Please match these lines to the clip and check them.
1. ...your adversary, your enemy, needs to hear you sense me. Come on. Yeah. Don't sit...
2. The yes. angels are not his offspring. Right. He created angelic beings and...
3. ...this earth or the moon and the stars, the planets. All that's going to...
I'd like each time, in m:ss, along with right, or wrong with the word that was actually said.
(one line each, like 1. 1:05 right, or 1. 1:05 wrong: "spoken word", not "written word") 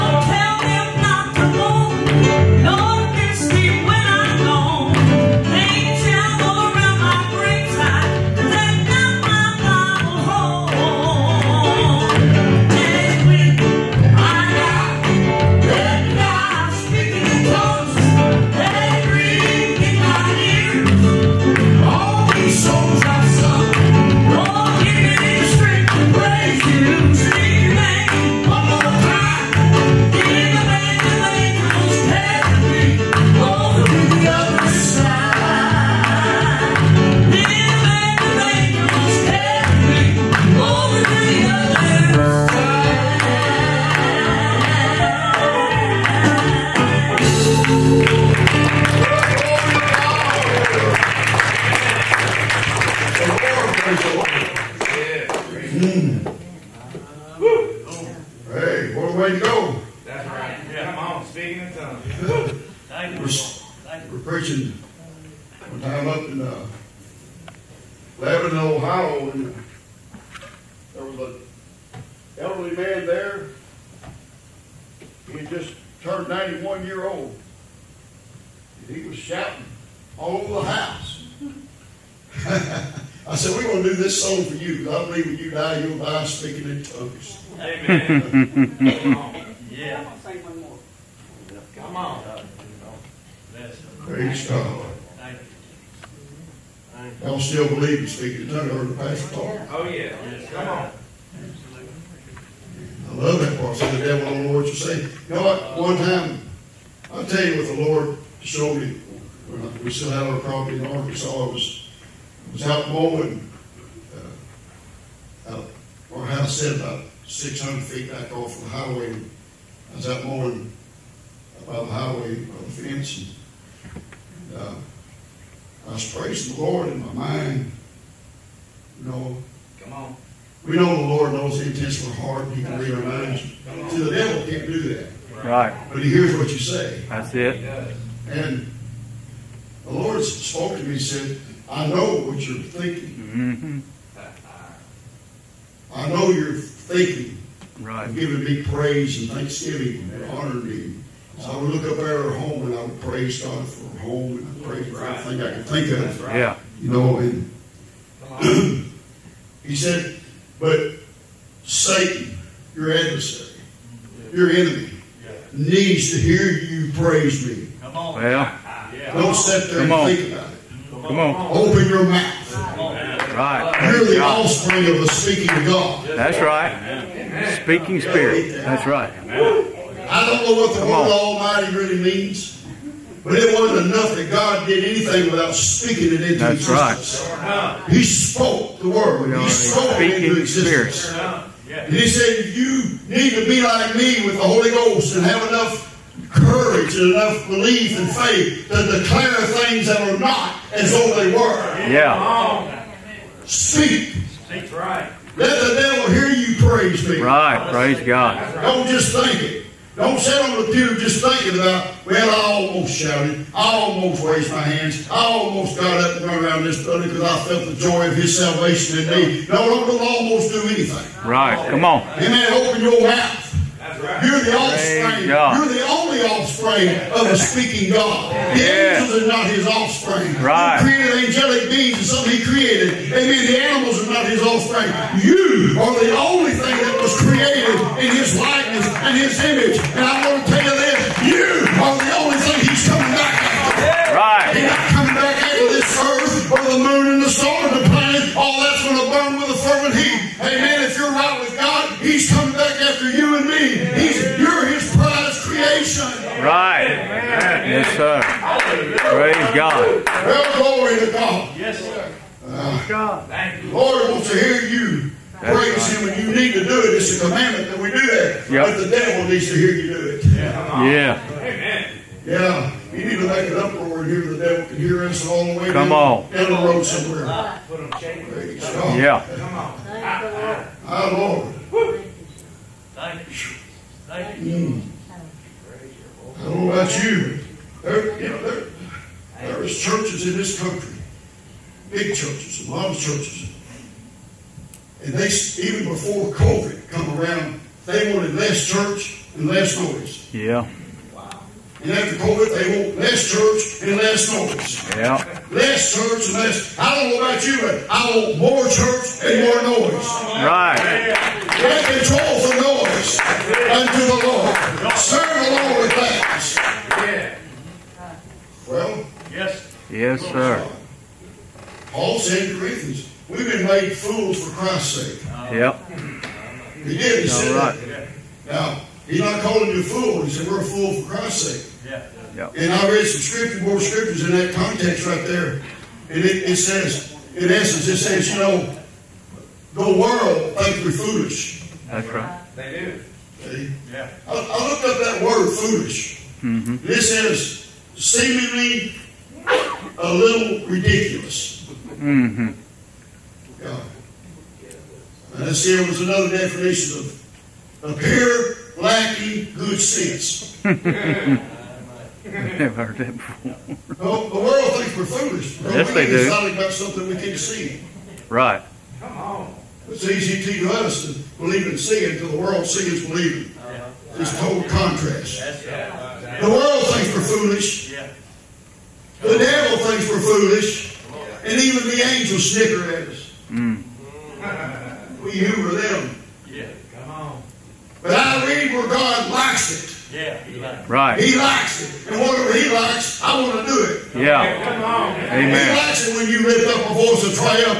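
1. 2:42 wrong: "praise", not "sense"
2. 3:48 right
3. 4:05 right.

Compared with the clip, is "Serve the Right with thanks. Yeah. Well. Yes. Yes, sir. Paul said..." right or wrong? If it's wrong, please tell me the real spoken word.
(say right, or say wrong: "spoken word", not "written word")
wrong: "Lord", not "Right".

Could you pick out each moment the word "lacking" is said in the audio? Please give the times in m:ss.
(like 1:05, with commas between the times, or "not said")
5:58.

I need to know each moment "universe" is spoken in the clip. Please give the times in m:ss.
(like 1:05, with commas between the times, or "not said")
not said.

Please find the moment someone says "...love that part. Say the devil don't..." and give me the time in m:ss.
1:43.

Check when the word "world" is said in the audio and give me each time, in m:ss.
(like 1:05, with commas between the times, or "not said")
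5:39, 6:04, 6:12, 6:16.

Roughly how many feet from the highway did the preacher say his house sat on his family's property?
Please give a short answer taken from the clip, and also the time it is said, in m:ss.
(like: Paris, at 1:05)
600, at 1:57.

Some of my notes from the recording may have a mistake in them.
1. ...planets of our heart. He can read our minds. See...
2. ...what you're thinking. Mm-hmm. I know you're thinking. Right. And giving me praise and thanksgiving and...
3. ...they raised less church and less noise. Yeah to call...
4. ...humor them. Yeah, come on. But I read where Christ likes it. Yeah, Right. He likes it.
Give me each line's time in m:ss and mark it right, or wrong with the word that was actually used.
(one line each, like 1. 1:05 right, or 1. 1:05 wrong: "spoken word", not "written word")
1. 2:11 wrong: "intents", not "planets"
2. 2:22 right
3. 4:57 wrong: "wanted", not "raised"
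4. 6:25 wrong: "God", not "Christ".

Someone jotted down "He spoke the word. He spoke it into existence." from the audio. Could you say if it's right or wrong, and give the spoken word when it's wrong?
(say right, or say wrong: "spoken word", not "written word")
right.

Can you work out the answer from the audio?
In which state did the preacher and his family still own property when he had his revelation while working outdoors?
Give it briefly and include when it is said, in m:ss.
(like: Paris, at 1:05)
Arkansas, at 1:50.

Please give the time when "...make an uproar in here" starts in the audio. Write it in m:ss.
4:33.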